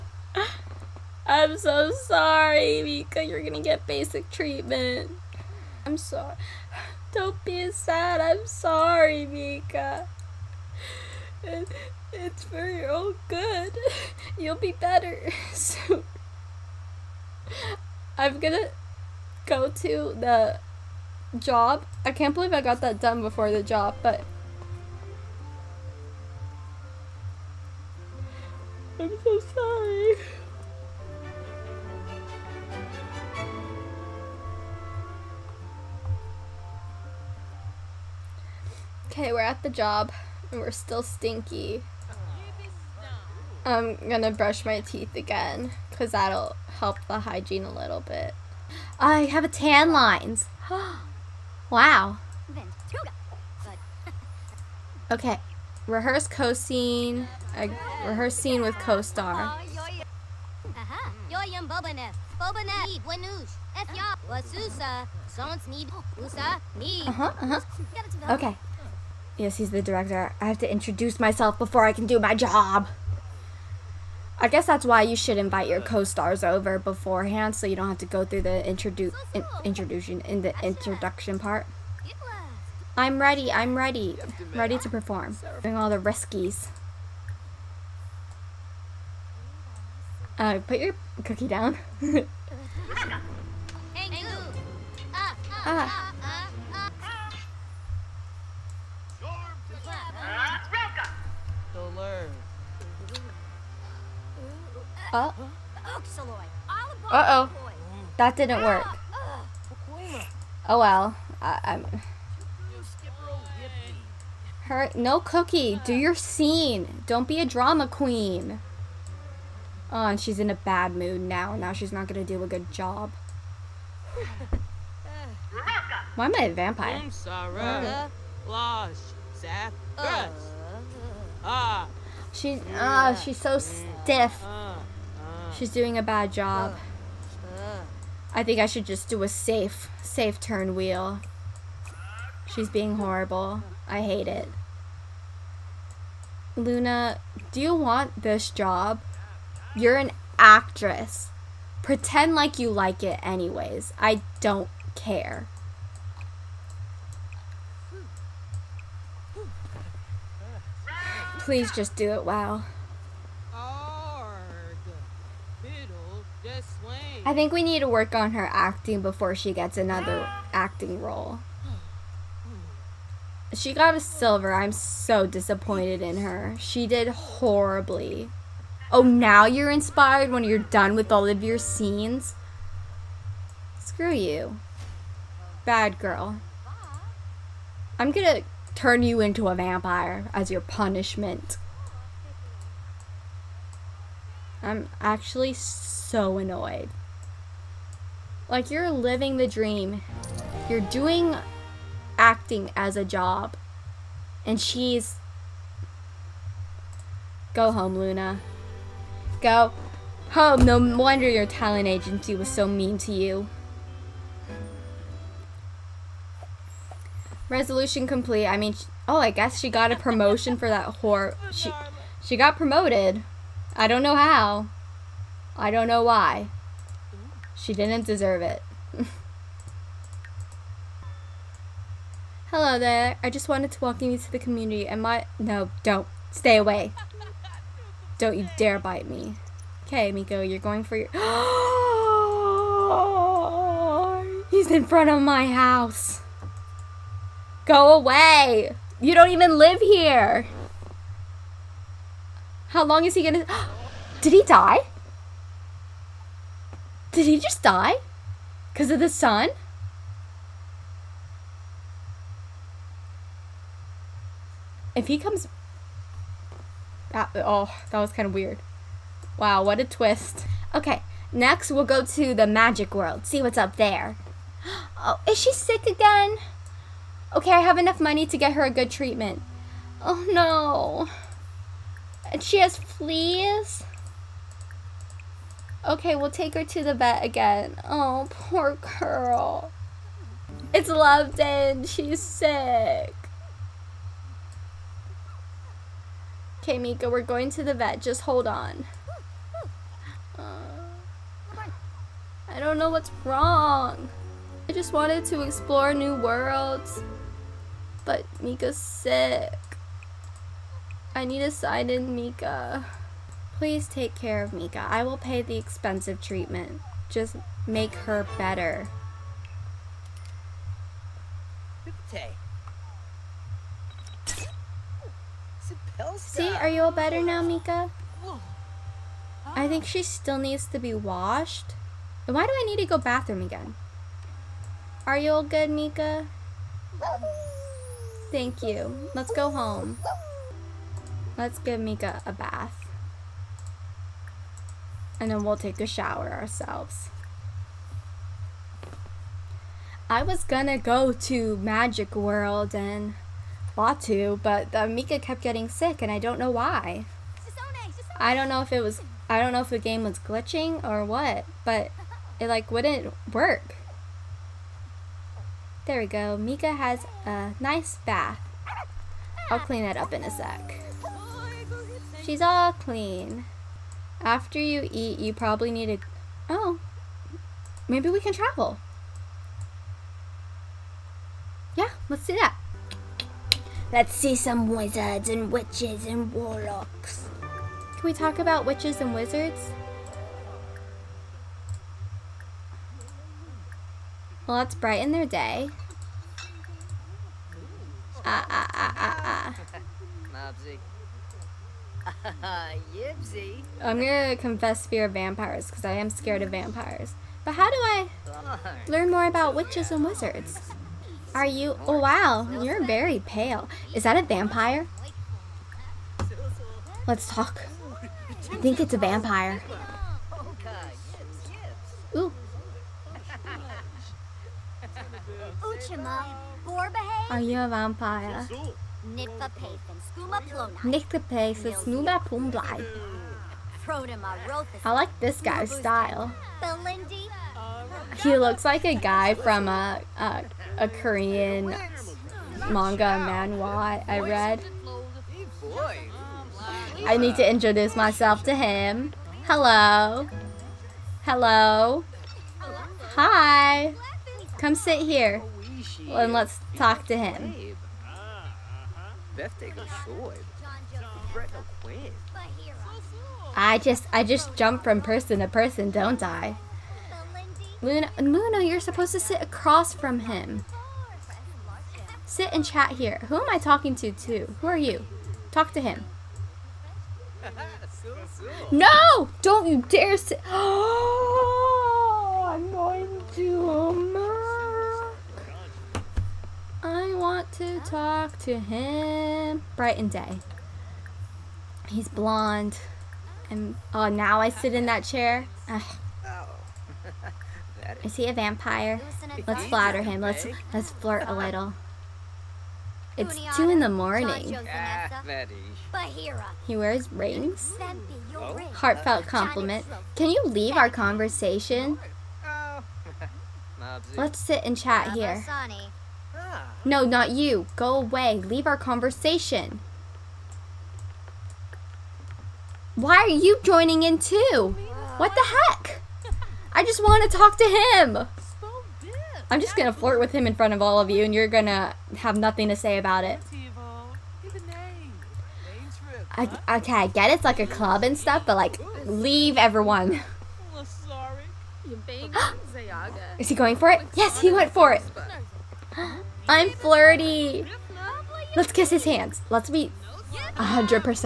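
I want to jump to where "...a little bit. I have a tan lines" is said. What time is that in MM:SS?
00:47.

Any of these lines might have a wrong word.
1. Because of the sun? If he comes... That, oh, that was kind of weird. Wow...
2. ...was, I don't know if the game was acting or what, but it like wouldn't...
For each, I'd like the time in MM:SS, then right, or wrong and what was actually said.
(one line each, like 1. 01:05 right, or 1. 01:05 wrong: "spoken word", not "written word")
1. 04:18 right
2. 05:58 wrong: "glitching", not "acting".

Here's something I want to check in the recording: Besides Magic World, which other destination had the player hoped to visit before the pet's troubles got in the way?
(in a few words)
Batuu.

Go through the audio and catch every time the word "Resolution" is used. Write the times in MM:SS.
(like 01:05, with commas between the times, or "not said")
03:37.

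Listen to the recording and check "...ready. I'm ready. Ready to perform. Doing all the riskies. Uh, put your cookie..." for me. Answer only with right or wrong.
right.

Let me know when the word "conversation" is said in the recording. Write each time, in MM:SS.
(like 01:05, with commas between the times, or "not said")
08:30, 08:38.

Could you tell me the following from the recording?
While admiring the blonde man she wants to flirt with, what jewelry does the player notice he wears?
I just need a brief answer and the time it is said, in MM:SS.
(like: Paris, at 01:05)
rings, at 08:27.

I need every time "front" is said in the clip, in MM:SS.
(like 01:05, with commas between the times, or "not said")
04:04, 08:50.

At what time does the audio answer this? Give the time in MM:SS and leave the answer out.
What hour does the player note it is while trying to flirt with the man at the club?
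08:23.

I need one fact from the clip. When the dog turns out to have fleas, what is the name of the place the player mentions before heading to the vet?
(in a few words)
Loveton.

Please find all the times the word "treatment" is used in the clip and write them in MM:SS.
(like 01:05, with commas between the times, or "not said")
00:04, 04:38, 05:16.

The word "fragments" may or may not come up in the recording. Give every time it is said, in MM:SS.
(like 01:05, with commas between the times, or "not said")
not said.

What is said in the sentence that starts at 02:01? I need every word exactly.
Now she's not gonna do a good job.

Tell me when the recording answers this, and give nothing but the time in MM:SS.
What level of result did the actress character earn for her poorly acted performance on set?
02:53.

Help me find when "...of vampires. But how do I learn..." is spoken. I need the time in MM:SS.
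06:46.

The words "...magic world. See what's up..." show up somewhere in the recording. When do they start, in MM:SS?
04:32.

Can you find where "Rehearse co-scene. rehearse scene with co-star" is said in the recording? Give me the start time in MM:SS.
00:55.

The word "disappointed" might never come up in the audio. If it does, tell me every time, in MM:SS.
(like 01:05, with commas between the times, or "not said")
02:55.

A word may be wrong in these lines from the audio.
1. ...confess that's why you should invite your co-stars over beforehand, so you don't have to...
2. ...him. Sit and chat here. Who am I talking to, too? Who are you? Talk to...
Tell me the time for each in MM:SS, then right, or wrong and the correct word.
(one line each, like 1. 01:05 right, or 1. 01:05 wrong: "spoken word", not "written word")
1. 01:14 wrong: "guess", not "confess"
2. 07:50 right.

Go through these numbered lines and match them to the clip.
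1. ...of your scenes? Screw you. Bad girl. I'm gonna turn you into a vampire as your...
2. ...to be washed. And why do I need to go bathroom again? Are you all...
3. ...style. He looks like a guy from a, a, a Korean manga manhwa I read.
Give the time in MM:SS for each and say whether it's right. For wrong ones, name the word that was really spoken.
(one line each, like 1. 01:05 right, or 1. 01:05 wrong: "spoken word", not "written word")
1. 03:01 right
2. 05:30 right
3. 07:15 right.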